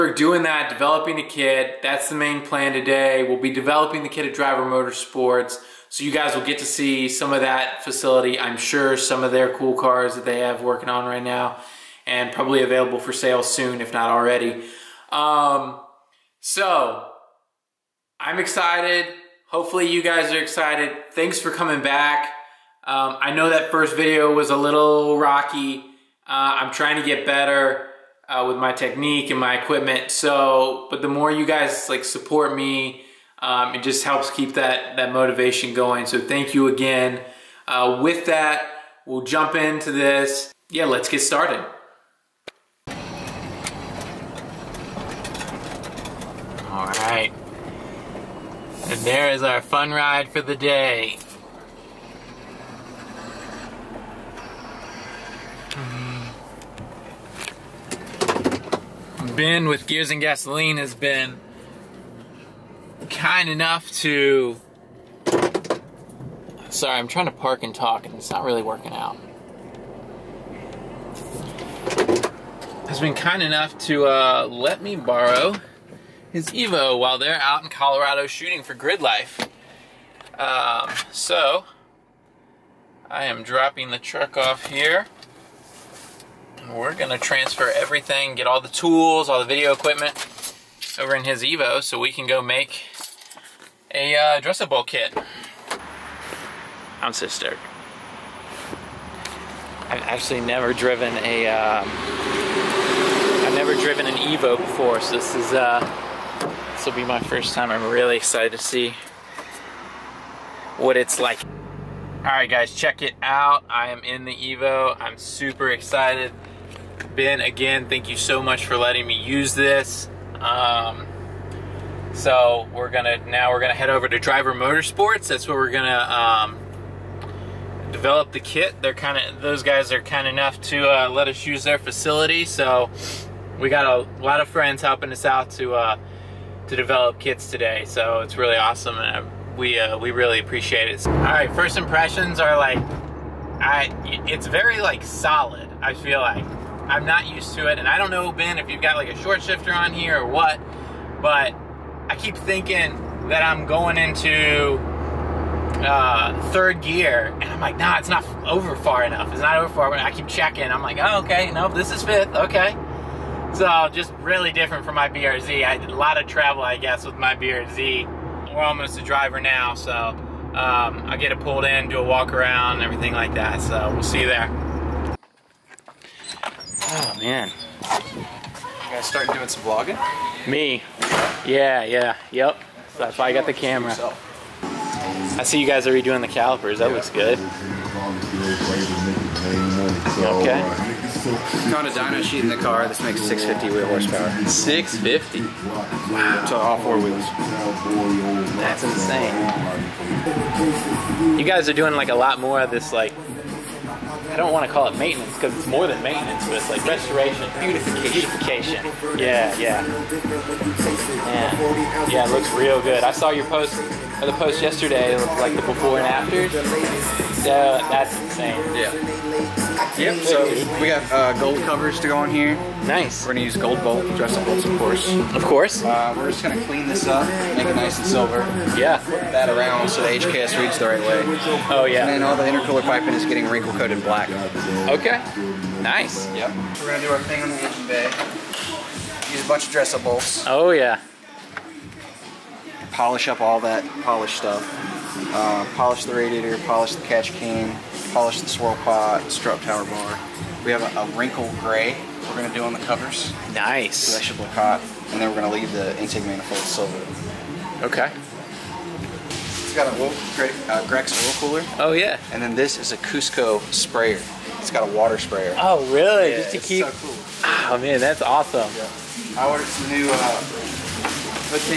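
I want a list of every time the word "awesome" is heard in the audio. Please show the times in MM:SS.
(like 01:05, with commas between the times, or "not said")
02:18, 04:28.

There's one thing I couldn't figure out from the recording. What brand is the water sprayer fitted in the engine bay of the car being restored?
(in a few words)
Cusco.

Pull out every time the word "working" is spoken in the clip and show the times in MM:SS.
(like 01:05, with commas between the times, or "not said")
00:10, 01:08.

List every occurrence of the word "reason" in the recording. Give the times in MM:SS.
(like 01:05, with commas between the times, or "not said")
not said.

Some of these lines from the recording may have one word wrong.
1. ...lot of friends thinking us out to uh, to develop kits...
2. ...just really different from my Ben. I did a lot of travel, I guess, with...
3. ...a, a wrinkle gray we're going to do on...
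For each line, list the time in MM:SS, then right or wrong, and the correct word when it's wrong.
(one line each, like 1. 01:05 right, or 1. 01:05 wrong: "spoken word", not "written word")
1. 02:14 wrong: "helping", not "thinking"
2. 02:43 wrong: "BRZ", not "Ben"
3. 04:10 right.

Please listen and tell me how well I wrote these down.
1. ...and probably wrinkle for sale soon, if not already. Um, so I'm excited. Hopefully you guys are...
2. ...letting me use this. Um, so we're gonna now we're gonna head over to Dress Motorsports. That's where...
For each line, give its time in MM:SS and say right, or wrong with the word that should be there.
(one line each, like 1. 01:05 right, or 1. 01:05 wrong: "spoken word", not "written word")
1. 00:12 wrong: "available", not "wrinkle"
2. 01:58 wrong: "Driver", not "Dress".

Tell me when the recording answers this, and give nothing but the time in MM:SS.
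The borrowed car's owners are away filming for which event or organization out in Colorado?
01:18.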